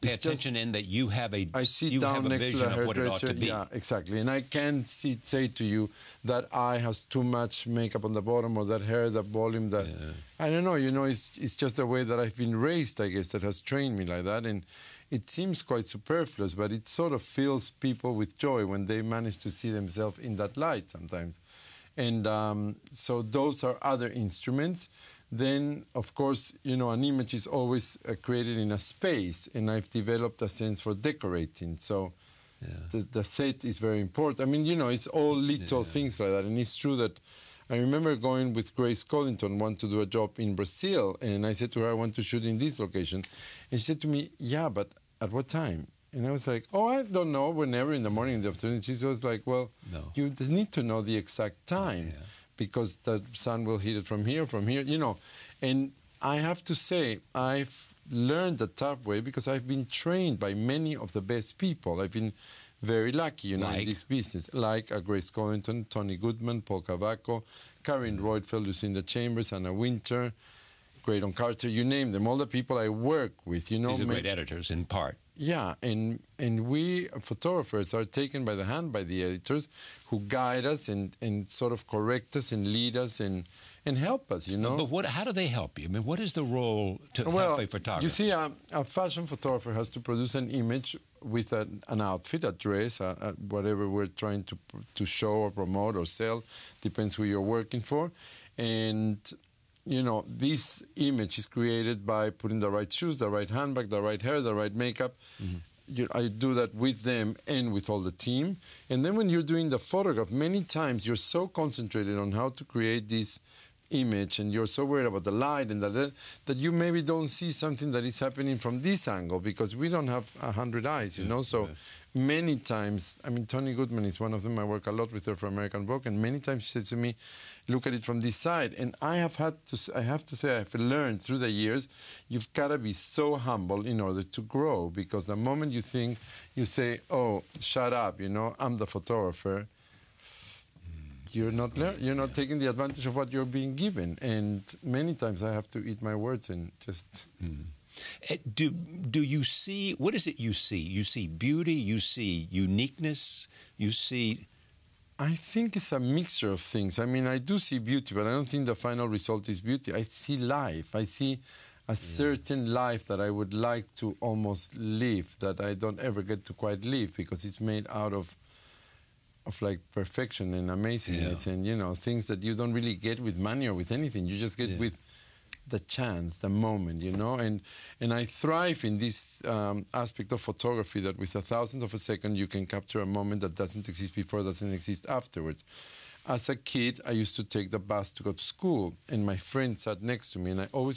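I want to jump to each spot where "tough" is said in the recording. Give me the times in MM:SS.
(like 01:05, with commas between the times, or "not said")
00:58.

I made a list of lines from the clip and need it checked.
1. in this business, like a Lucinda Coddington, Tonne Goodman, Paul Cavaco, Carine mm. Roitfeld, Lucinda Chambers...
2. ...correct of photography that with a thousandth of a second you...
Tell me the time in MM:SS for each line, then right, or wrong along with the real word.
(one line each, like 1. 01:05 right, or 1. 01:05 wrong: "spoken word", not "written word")
1. 01:03 wrong: "Grace", not "Lucinda"
2. 02:59 wrong: "aspect", not "correct".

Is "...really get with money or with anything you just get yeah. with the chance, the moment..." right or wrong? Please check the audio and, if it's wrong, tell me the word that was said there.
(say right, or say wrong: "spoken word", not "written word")
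right.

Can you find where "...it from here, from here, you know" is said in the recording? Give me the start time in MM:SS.
00:53.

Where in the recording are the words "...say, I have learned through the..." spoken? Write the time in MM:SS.
02:10.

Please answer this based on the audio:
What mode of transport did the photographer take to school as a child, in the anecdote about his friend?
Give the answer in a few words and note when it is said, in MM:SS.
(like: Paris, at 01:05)
Bus, at 03:07.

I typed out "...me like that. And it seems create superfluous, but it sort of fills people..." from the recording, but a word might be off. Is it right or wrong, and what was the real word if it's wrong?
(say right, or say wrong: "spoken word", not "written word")
wrong: "quite", not "create".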